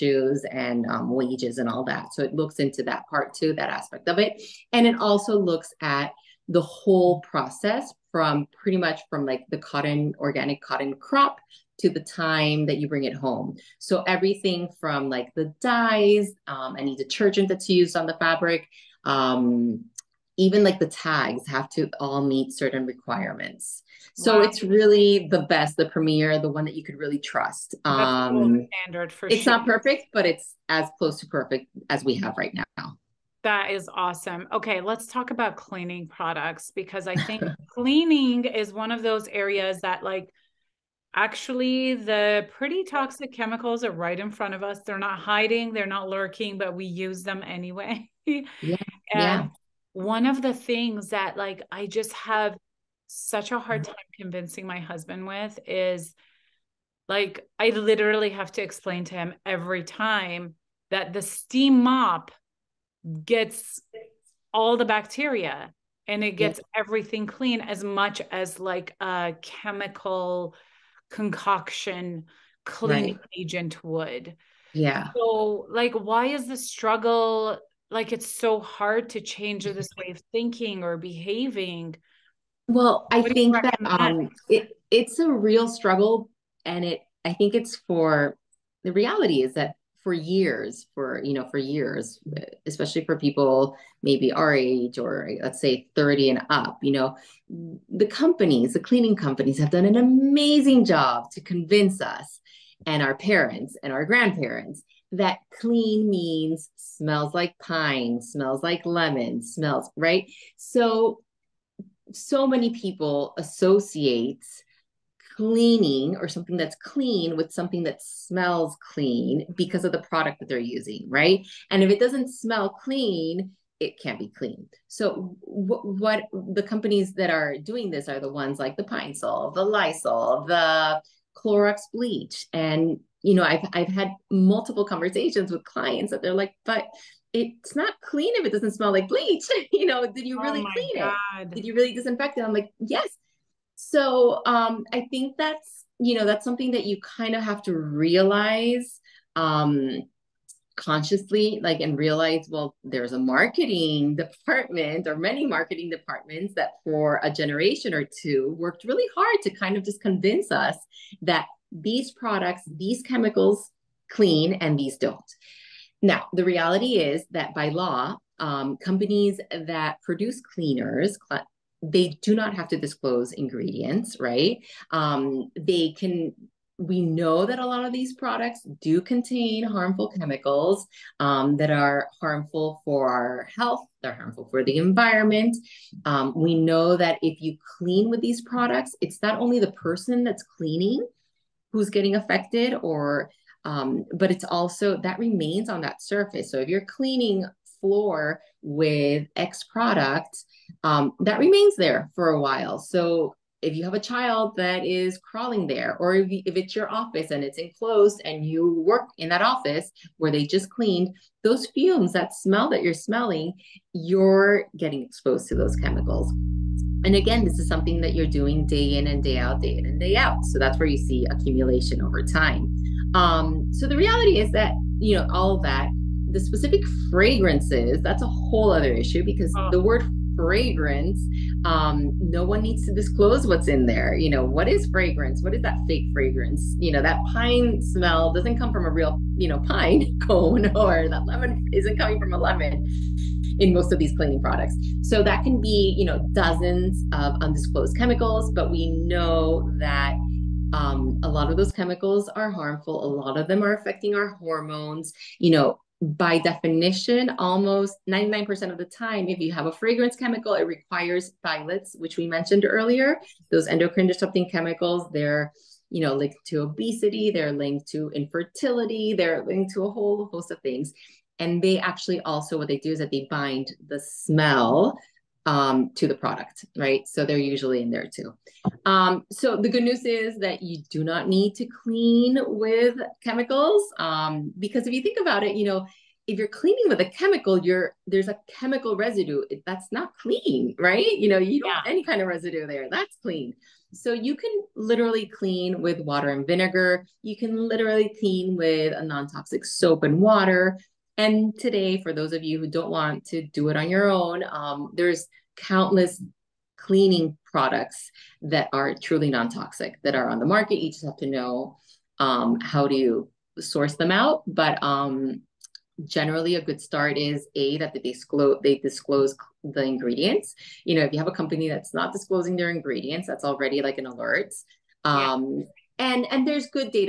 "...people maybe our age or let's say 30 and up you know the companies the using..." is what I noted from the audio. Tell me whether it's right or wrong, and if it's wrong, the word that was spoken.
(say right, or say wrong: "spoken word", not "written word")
wrong: "cleaning", not "using".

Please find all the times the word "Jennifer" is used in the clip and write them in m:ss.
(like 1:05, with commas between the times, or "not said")
not said.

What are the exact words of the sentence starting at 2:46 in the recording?
Now, the reality is that by law, um, companies that produce cleaners, cl- they do not have to disclose ingredients, right?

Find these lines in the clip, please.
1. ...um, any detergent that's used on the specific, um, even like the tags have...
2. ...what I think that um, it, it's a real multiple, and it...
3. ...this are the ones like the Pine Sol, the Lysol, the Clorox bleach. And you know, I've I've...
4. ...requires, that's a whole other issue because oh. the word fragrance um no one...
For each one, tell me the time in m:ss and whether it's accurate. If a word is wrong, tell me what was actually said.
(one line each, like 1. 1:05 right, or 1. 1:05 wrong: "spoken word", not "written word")
1. 0:16 wrong: "fabric", not "specific"
2. 1:23 wrong: "struggle", not "multiple"
3. 2:07 right
4. 3:47 wrong: "fragrances", not "requires".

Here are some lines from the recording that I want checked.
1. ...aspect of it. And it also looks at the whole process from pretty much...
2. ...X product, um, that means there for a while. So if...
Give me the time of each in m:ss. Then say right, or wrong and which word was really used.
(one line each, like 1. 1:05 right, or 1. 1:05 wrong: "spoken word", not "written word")
1. 0:03 right
2. 3:19 wrong: "remains", not "means".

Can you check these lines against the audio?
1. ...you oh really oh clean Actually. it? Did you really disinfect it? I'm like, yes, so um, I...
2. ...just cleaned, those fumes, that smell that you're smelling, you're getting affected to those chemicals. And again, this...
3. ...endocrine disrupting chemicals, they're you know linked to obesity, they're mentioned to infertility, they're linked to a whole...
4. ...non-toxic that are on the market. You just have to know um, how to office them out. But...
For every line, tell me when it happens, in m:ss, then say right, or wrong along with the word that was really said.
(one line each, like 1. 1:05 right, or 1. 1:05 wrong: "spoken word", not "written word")
1. 2:20 wrong: "God", not "Actually"
2. 3:30 wrong: "exposed", not "affected"
3. 4:23 wrong: "linked", not "mentioned"
4. 5:09 wrong: "source", not "office".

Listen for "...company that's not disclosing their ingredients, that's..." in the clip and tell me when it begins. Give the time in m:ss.
5:21.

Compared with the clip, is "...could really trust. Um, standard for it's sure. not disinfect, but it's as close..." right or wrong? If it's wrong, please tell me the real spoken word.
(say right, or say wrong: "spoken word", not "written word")
wrong: "perfect", not "disinfect".